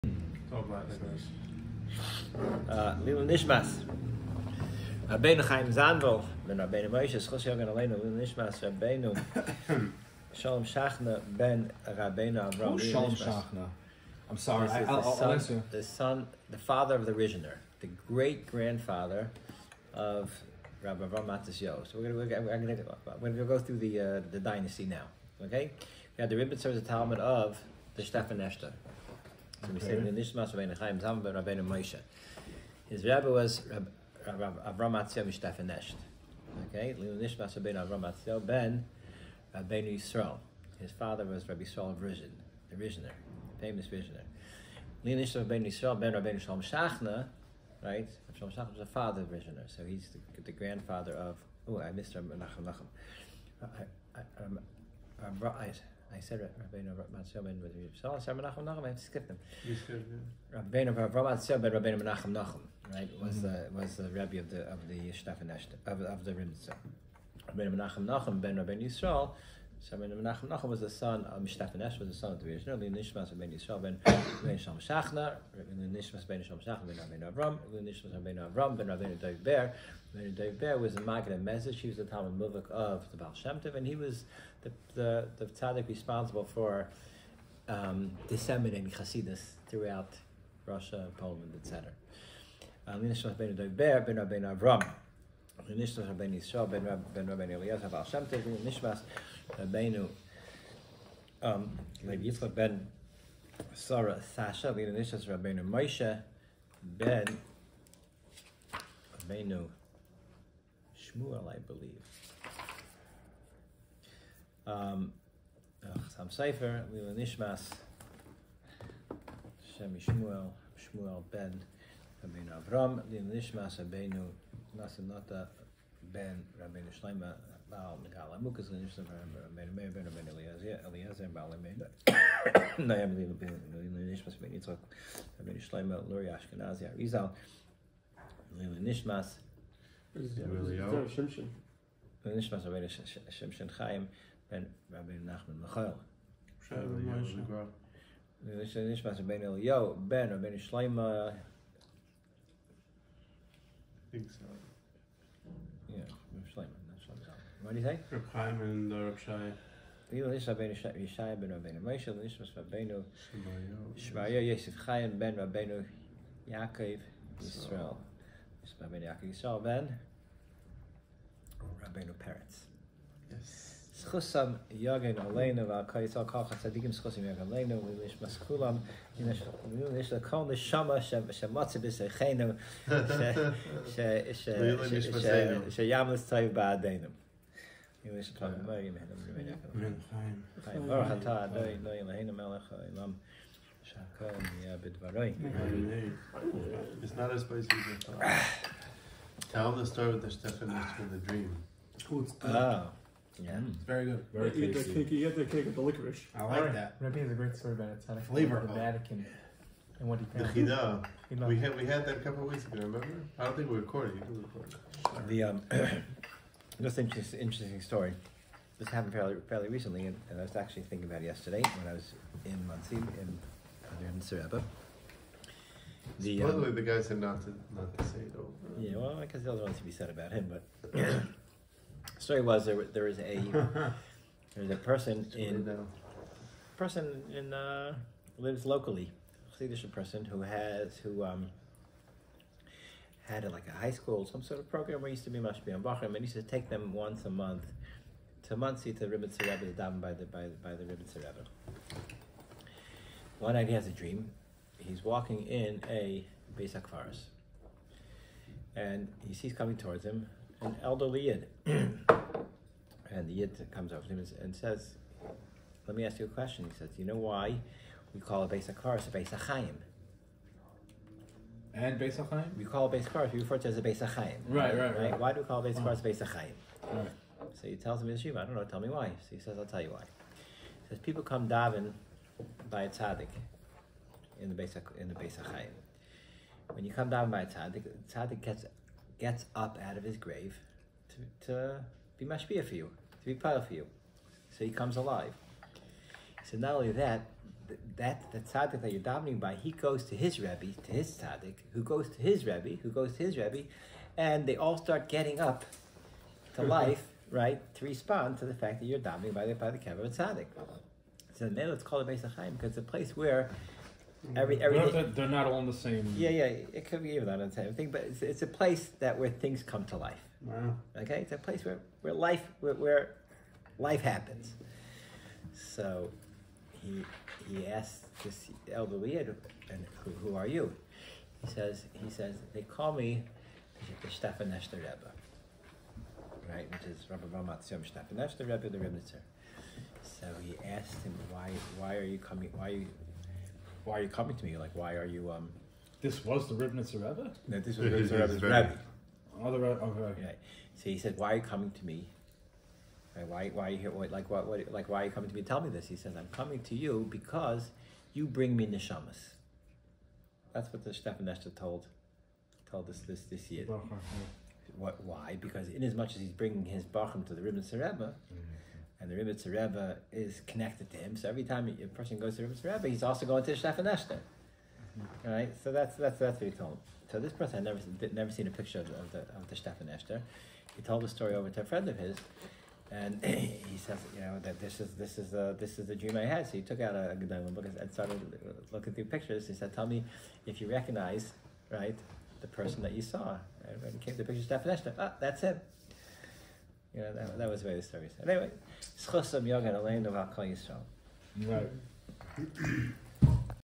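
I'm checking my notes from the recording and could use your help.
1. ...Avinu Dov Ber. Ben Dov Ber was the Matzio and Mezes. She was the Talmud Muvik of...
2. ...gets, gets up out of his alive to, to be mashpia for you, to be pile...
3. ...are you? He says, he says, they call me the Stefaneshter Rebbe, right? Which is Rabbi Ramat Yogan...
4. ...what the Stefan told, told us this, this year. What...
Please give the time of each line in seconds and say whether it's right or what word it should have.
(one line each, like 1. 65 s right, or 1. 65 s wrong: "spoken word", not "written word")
1. 78 s wrong: "Maggid", not "Matzio"
2. 288 s wrong: "grave", not "alive"
3. 330 s wrong: "Stefan", not "Yogan"
4. 360 s right.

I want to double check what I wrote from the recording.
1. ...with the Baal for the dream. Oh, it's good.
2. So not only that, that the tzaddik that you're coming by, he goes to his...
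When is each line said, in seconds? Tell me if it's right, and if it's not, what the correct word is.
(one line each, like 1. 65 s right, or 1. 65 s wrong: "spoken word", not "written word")
1. 200 s wrong: "Stephanus", not "Baal"
2. 296 s wrong: "davening", not "coming".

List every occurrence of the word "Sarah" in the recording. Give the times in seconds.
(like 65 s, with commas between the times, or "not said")
103 s.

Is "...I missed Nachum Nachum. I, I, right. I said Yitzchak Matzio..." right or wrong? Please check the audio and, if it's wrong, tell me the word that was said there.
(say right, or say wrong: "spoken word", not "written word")
wrong: "Rabbeinu", not "Yitzchak".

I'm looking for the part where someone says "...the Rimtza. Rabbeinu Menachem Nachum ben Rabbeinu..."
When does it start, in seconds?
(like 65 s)
66 s.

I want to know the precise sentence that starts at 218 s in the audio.
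This happened fairly, fairly recently, and, and, I was actually thinking about it yesterday when I was in Mansim in, in Surabba.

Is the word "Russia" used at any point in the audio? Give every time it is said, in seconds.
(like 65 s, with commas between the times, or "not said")
90 s.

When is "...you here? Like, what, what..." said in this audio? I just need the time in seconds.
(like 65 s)
353 s.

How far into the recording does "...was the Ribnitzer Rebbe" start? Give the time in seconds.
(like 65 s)
346 s.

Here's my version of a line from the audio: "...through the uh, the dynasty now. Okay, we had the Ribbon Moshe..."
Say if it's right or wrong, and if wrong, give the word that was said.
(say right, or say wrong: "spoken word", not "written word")
wrong: "Service", not "Moshe".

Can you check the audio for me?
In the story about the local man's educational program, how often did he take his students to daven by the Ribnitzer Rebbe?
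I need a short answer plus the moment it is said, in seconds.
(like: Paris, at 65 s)
Once a month, at 246 s.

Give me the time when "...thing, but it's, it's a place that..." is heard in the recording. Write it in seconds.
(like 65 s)
317 s.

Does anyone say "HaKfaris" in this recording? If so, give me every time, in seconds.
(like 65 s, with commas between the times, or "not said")
256 s, 268 s.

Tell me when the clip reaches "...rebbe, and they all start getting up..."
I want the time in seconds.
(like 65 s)
303 s.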